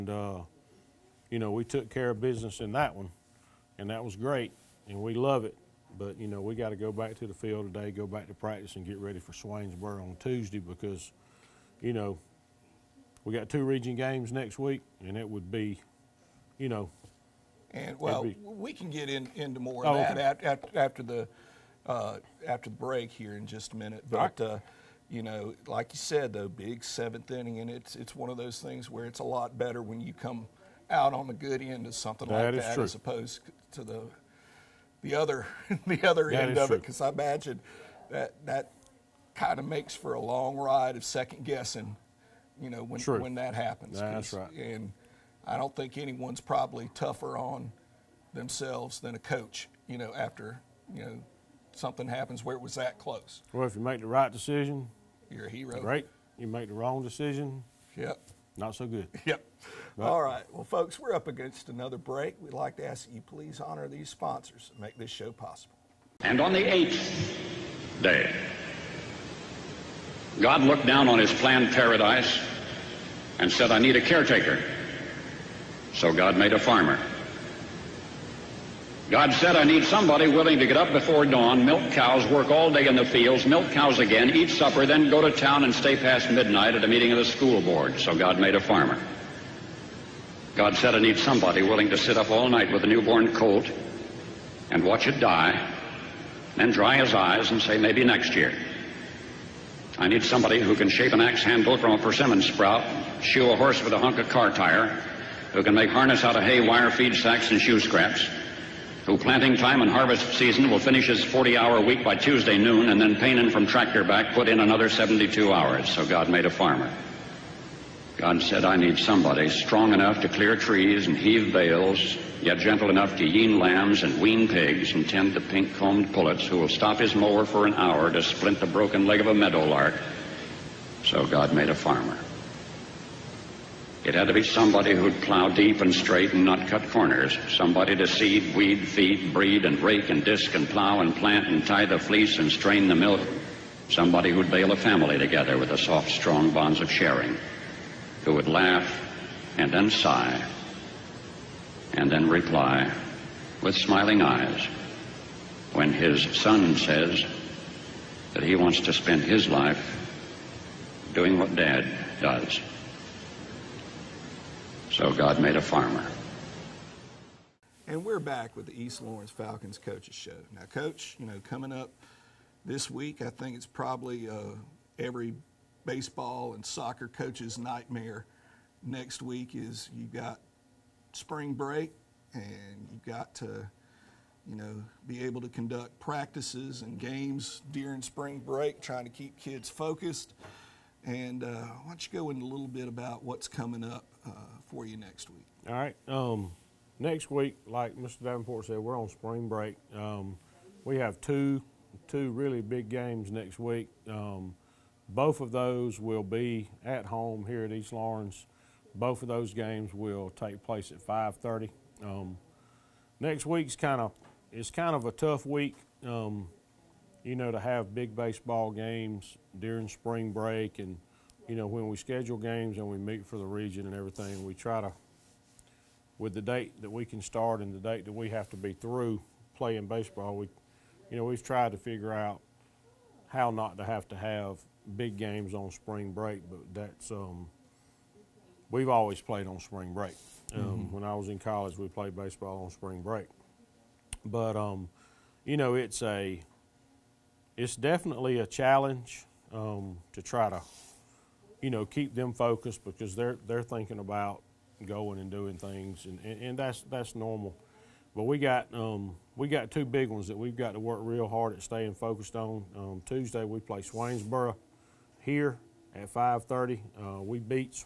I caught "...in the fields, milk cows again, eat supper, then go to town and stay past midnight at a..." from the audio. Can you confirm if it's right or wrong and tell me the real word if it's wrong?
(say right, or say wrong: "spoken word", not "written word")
right.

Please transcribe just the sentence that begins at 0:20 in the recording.
after, after, the, uh, after the break here in just a minute.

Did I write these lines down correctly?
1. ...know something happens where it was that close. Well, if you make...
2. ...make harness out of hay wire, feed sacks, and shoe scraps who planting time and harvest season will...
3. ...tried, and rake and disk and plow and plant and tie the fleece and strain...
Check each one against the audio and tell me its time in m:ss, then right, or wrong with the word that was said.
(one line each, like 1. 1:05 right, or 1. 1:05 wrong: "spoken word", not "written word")
1. 0:51 right
2. 1:45 right
3. 2:19 wrong: "breed", not "tried".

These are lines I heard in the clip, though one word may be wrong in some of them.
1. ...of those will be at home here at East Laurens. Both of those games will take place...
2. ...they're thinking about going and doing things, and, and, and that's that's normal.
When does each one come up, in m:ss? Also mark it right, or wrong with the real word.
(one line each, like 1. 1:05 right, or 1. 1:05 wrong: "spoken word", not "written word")
1. 3:25 right
2. 4:13 right.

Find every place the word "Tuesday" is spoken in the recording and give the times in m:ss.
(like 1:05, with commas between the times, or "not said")
0:10, 1:52, 4:23.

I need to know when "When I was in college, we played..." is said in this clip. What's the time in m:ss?
4:00.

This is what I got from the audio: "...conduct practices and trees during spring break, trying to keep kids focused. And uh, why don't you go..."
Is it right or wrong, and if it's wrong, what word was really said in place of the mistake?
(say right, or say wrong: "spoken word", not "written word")
wrong: "games", not "trees".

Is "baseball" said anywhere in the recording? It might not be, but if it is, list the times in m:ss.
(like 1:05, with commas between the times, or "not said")
2:55, 3:38, 3:49, 4:02.